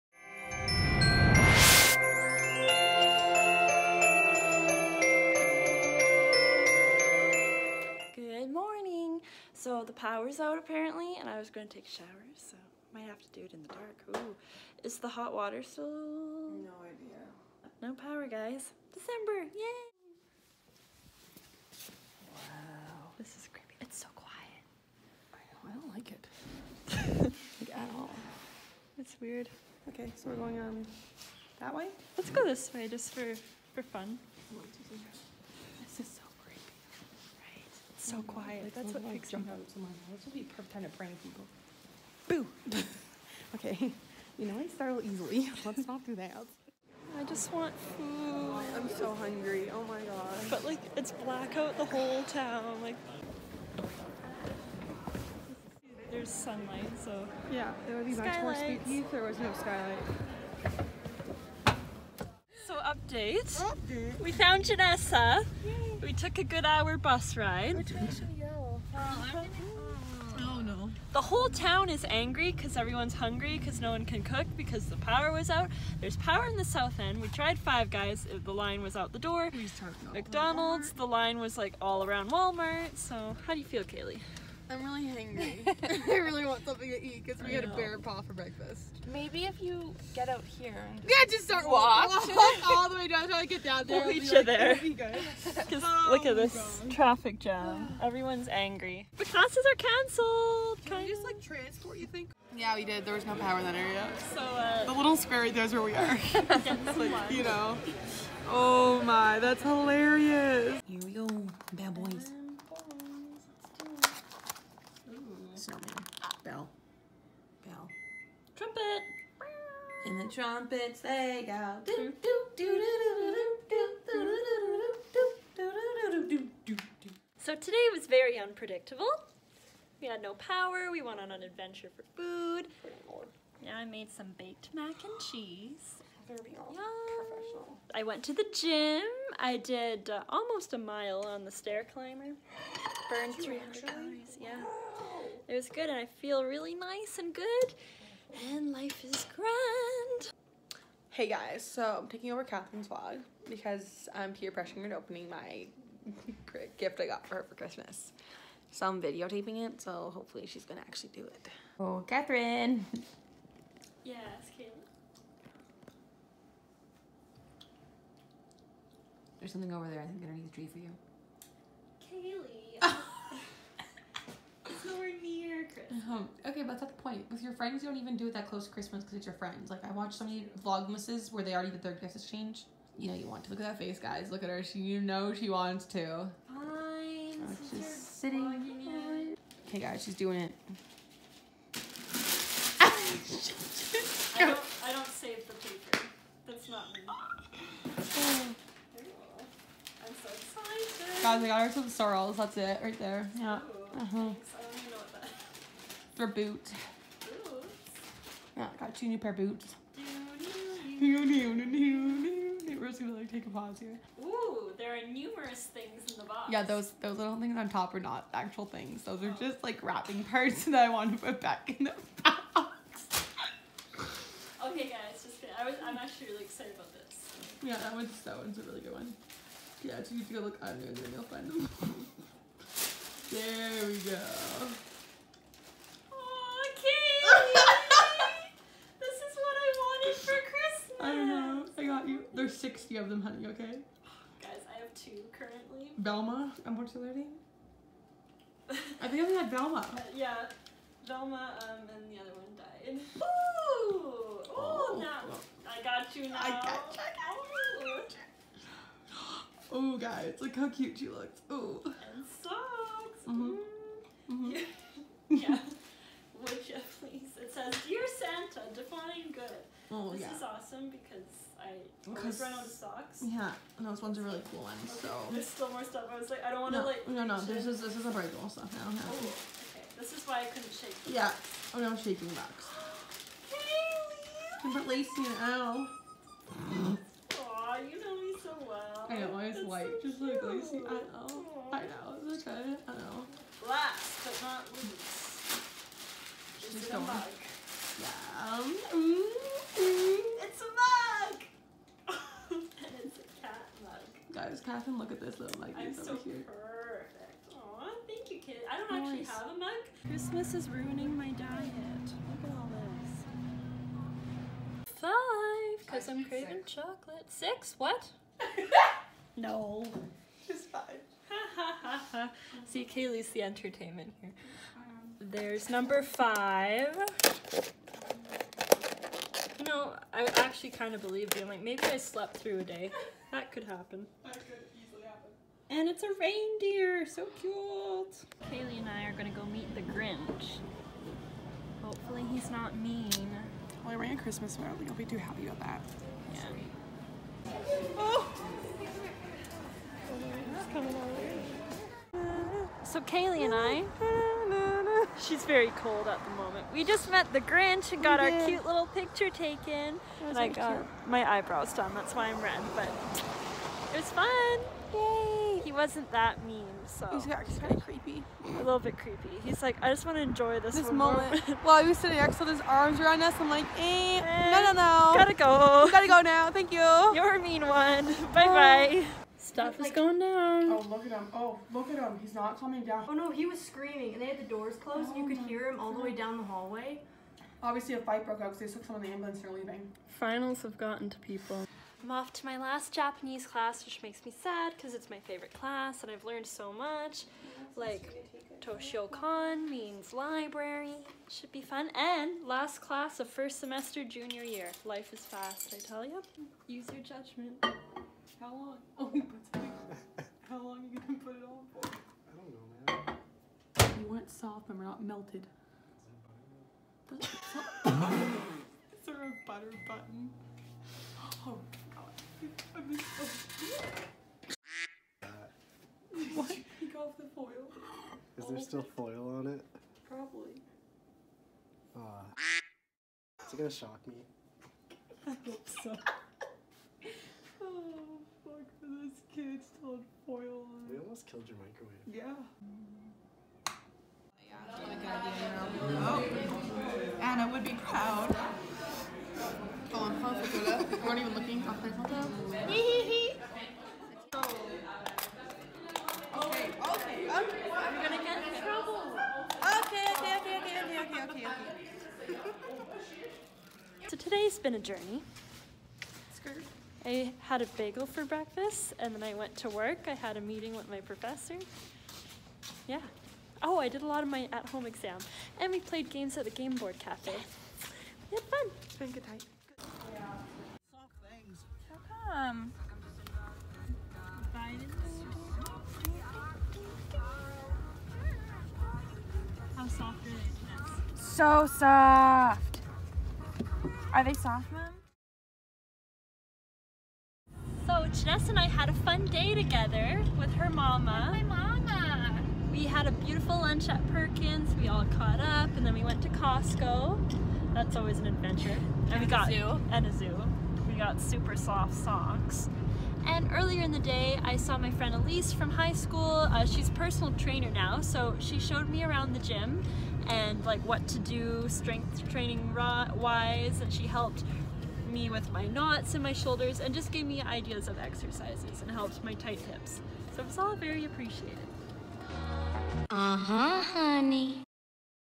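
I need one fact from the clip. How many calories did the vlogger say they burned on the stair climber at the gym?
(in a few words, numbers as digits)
300.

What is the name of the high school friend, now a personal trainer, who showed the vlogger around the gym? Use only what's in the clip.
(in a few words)
Elise.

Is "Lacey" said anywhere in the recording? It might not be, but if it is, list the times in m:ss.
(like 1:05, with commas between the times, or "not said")
4:44, 4:50.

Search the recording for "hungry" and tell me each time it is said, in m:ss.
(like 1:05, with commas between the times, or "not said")
0:49, 1:13, 1:25.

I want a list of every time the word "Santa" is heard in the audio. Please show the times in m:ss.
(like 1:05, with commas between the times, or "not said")
4:28.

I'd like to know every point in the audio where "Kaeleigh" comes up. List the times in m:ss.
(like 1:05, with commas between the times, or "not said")
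1:23, 5:22, 5:38, 5:52.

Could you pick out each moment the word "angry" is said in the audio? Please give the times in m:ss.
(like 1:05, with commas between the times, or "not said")
1:12, 1:38.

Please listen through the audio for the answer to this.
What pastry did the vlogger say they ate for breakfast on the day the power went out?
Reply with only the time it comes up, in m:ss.
1:27.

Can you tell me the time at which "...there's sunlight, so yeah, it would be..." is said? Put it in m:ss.
0:56.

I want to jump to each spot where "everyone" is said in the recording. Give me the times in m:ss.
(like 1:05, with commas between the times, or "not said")
1:12, 1:38.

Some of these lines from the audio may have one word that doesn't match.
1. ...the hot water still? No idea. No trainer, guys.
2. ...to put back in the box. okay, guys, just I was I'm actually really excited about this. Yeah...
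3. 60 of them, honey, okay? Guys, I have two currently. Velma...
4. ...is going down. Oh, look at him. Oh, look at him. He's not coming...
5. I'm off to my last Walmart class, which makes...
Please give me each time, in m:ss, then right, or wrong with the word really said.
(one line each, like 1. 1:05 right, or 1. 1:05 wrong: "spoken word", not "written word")
1. 0:14 wrong: "power", not "trainer"
2. 3:41 right
3. 4:02 right
4. 6:19 right
5. 6:32 wrong: "Japanese", not "Walmart".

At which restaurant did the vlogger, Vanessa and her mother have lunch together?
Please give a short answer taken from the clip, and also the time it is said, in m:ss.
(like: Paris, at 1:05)
Perkins, at 8:24.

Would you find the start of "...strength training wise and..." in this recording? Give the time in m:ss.
8:41.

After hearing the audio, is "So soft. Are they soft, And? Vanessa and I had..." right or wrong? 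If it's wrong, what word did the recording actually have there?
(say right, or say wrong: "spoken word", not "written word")
wrong: "Mom", not "And".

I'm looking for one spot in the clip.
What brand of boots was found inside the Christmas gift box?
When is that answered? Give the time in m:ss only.
3:21.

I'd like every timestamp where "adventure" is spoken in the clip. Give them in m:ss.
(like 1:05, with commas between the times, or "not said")
2:11, 8:28.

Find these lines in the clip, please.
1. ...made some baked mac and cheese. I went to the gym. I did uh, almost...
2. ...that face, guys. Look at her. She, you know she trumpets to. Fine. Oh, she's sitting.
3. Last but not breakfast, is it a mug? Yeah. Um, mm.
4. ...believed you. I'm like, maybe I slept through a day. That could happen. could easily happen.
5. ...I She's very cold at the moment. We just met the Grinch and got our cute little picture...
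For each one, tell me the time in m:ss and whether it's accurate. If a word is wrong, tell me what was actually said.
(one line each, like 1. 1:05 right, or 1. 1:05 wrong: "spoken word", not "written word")
1. 2:13 right
2. 3:03 wrong: "wants", not "trumpets"
3. 4:53 wrong: "least", not "breakfast"
4. 5:31 right
5. 5:53 right.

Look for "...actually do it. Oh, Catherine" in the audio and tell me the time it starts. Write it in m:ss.
2:40.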